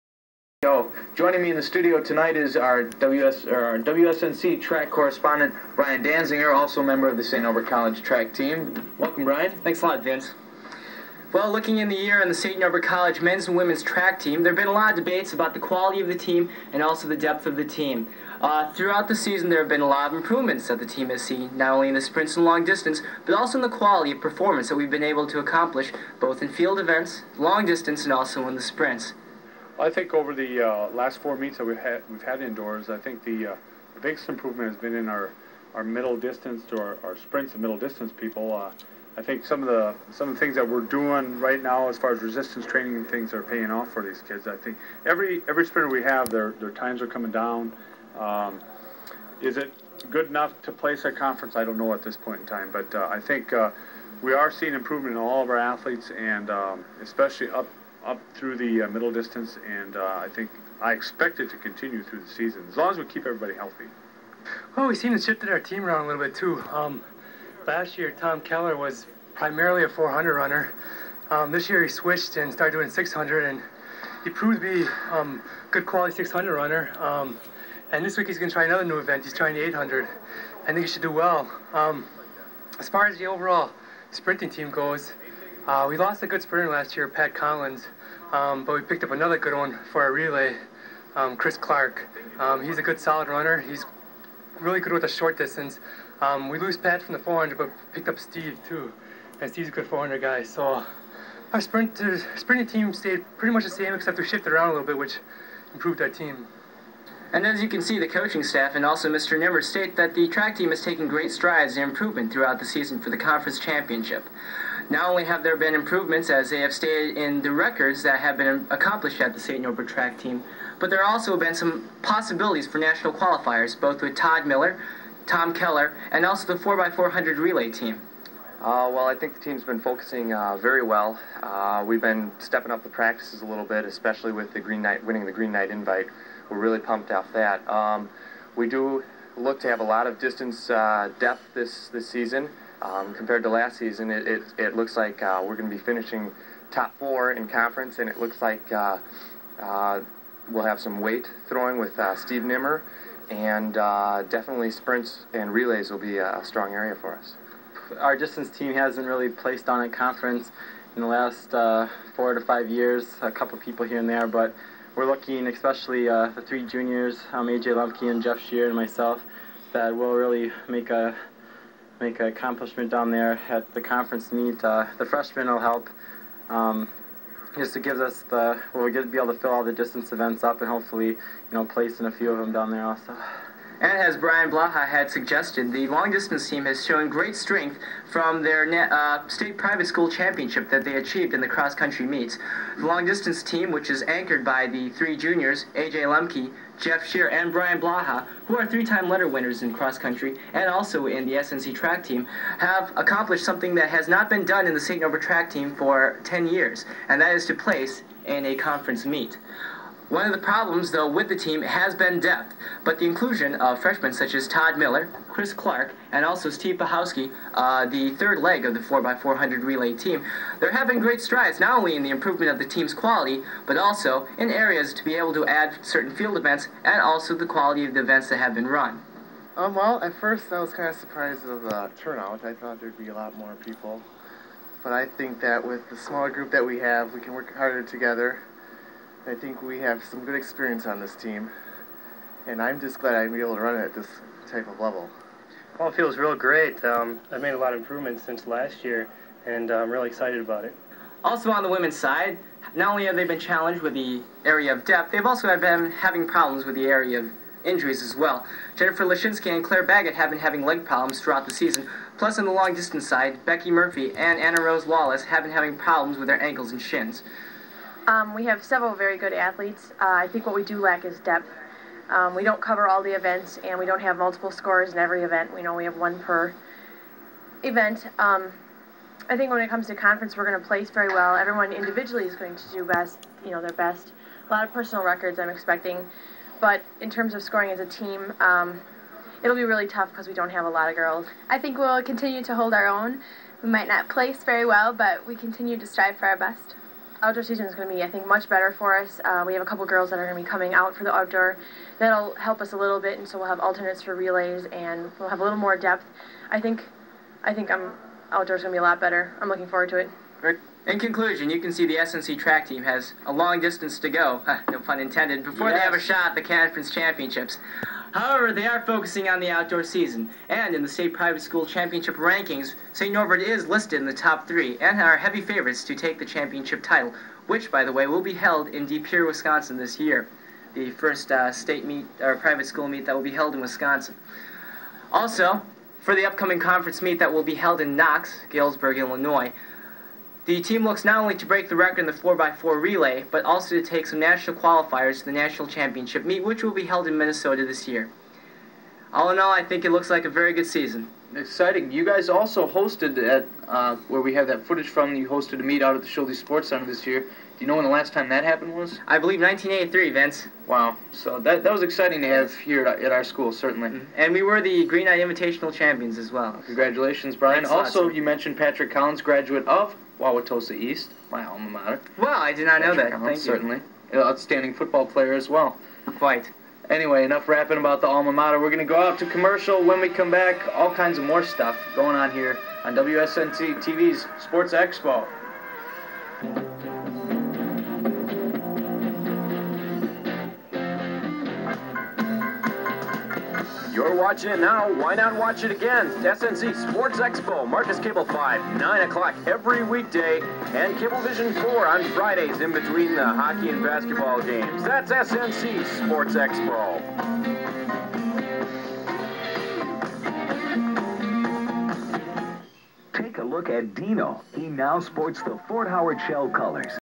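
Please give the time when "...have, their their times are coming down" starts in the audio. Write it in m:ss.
0:46.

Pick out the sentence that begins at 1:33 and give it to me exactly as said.
He's really good with the short distance.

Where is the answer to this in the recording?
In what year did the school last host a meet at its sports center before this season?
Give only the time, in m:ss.
5:59.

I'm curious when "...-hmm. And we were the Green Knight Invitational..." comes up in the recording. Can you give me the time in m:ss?
6:03.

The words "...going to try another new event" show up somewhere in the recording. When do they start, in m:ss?
1:18.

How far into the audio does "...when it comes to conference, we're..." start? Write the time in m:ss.
4:39.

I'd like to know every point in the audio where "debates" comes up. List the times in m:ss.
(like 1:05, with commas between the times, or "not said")
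0:14.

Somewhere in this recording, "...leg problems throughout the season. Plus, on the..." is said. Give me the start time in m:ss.
4:20.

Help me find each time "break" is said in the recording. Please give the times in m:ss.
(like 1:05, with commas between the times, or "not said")
5:41.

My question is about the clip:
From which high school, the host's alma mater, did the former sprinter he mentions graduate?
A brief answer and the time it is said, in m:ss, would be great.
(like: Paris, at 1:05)
Wauwatosa East, at 6:10.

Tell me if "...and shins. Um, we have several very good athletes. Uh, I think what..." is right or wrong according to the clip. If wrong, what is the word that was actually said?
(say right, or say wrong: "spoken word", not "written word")
right.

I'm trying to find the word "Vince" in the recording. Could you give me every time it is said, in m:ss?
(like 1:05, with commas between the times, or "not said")
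0:10, 6:00.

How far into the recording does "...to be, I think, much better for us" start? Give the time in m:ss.
4:57.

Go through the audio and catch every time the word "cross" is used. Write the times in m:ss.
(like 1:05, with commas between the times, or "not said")
3:11, 3:19.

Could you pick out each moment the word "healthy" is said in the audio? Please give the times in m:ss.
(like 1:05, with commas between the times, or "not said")
1:03.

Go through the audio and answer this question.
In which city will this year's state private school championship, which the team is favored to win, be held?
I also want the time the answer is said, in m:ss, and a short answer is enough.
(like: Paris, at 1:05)
De Pere, at 5:28.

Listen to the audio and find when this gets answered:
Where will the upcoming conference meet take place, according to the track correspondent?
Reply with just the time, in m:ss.
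5:38.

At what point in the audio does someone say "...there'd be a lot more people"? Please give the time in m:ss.
3:52.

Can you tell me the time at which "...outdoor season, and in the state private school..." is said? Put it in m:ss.
5:19.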